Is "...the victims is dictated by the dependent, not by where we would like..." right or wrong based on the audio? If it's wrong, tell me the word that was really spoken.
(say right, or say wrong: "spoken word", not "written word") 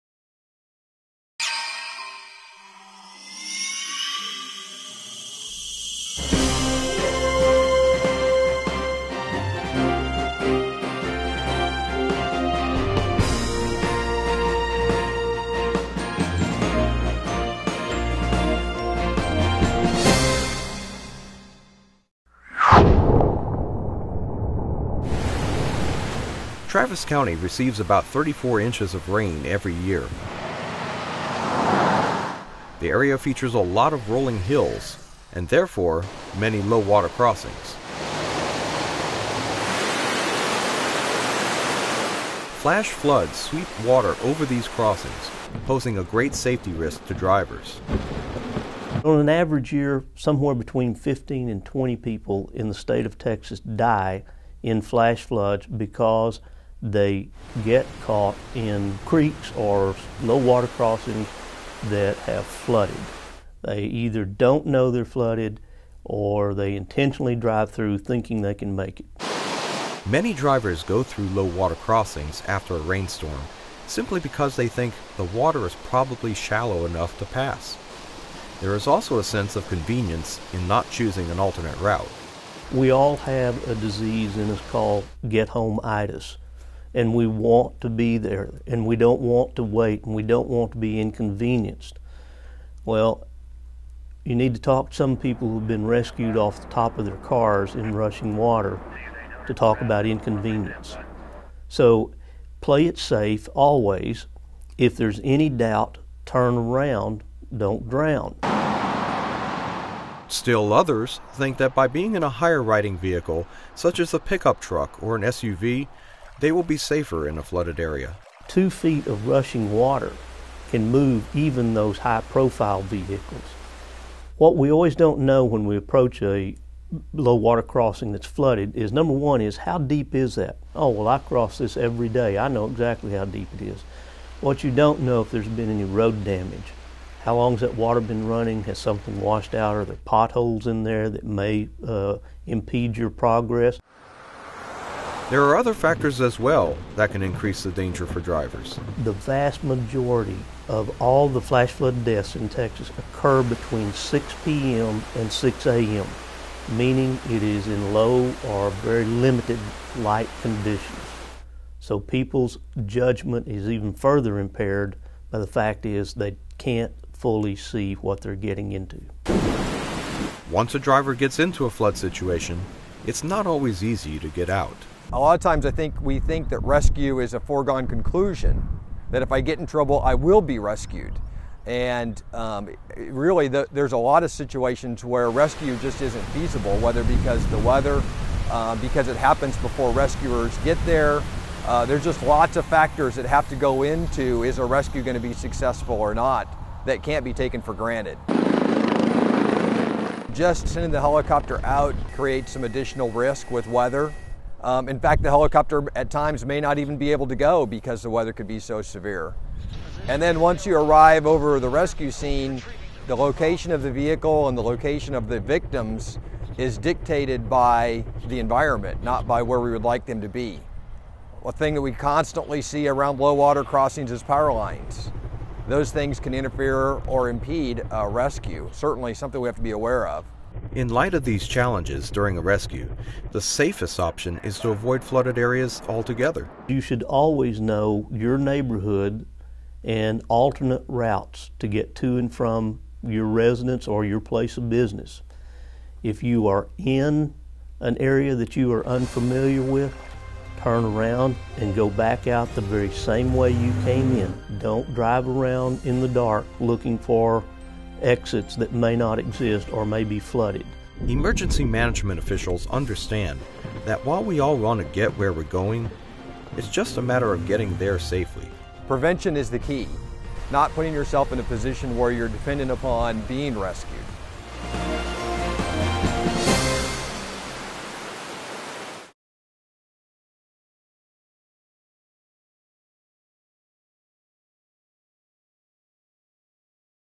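wrong: "environment", not "dependent".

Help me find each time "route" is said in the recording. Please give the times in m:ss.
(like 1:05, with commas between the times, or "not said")
1:21, 4:00.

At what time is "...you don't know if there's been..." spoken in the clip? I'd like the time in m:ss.
2:14.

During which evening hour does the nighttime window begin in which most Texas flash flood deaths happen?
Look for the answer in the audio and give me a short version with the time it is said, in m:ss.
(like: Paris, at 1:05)
6 p.m., at 2:33.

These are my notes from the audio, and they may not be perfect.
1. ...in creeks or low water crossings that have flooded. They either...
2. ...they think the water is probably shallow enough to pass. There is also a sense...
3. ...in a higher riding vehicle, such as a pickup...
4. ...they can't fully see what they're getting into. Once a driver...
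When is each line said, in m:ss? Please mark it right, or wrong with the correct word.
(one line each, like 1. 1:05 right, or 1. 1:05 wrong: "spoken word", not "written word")
1. 0:58 right
2. 1:14 right
3. 1:52 right
4. 2:46 right.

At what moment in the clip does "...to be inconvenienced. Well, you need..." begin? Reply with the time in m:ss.
1:30.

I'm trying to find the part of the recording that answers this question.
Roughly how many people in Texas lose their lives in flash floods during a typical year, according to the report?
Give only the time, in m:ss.
0:50.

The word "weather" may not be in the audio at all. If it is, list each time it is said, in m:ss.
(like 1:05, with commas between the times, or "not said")
3:07, 3:23, 3:28.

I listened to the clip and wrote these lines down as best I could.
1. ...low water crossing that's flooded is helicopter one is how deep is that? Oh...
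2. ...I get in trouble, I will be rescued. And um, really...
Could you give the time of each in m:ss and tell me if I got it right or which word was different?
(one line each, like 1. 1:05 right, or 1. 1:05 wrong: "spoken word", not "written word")
1. 2:07 wrong: "number", not "helicopter"
2. 2:59 right.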